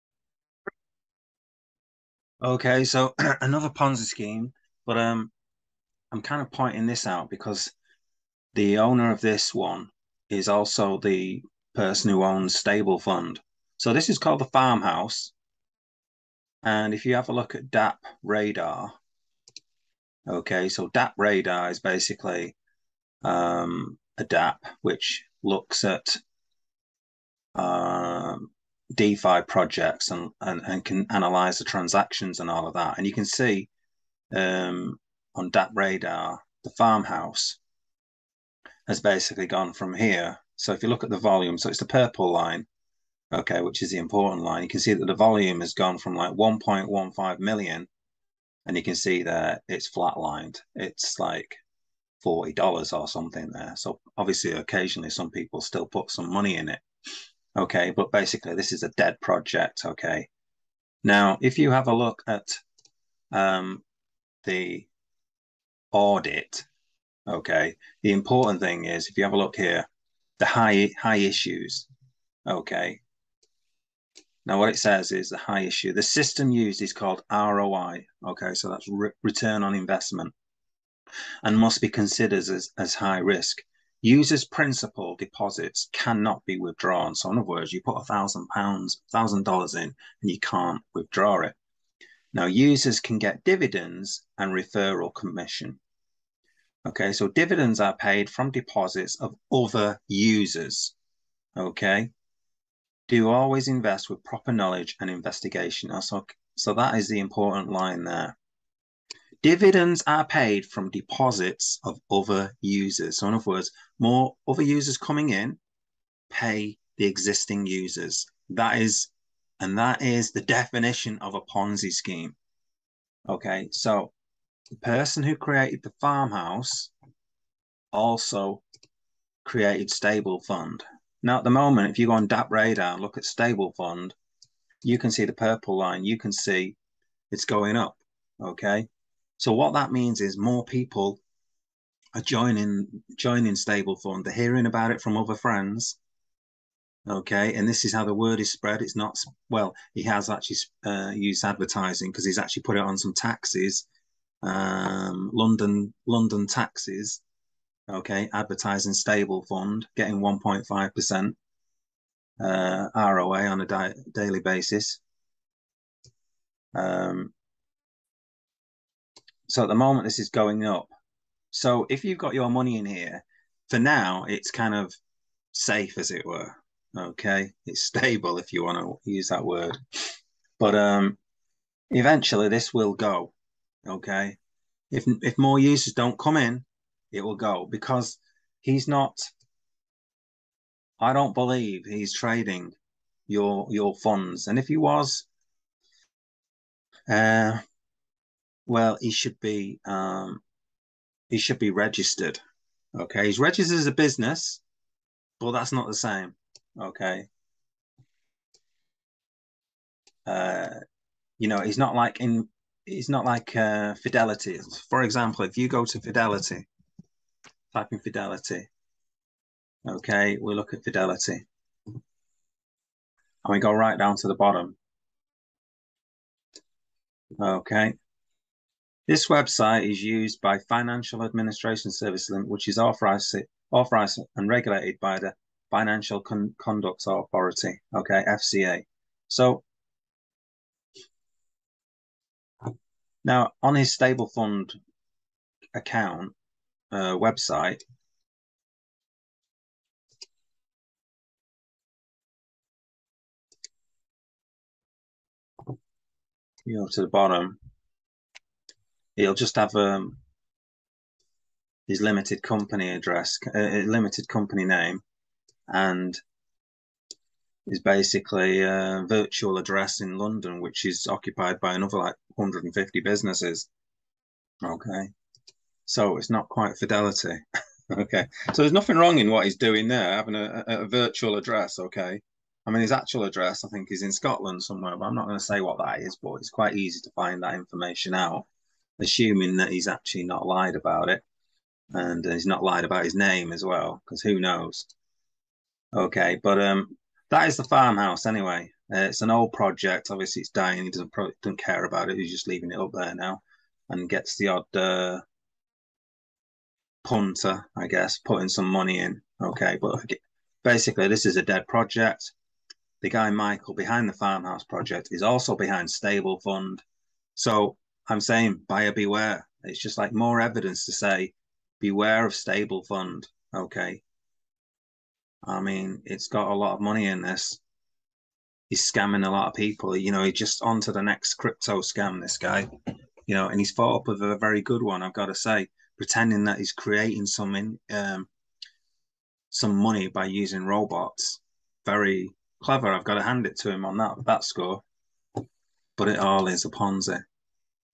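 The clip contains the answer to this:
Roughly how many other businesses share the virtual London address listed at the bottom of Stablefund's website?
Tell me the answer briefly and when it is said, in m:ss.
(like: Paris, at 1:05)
150, at 4:32.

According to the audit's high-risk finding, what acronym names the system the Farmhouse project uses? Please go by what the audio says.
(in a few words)
ROI.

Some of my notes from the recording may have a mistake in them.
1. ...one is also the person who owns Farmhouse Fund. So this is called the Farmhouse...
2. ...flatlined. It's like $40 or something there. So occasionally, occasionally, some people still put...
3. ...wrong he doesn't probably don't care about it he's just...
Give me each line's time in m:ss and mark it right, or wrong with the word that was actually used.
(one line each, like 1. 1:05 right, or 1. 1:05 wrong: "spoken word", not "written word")
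1. 0:09 wrong: "Stable", not "Farmhouse"
2. 0:49 wrong: "obviously", not "occasionally"
3. 5:00 wrong: "dying", not "wrong".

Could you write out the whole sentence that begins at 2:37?
Okay, advertising Stablefund, getting 1.5 percent uh, ROA on a daily basis.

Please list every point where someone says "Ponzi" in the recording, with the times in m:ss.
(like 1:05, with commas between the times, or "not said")
0:03, 2:01, 5:46.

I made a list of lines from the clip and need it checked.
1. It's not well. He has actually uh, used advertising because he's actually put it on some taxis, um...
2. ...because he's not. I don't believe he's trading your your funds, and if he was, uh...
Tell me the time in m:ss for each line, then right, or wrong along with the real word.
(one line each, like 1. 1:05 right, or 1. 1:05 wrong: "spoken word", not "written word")
1. 2:28 right
2. 3:07 right.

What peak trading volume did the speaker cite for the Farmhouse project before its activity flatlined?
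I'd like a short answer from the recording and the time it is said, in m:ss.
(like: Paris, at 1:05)
1.15 million, at 0:46.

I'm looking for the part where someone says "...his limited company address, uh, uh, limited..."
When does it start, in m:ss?
4:21.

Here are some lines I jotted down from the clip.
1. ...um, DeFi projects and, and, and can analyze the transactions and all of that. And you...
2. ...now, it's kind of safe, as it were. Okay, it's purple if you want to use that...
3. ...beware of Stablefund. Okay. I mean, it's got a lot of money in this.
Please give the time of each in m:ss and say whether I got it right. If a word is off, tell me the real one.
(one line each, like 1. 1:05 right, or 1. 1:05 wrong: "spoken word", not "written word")
1. 0:27 right
2. 2:53 wrong: "stable", not "purple"
3. 5:21 right.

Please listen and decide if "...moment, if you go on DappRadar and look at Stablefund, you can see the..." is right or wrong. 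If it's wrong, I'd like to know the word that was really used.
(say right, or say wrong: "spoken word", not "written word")
right.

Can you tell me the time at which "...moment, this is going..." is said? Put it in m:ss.
2:49.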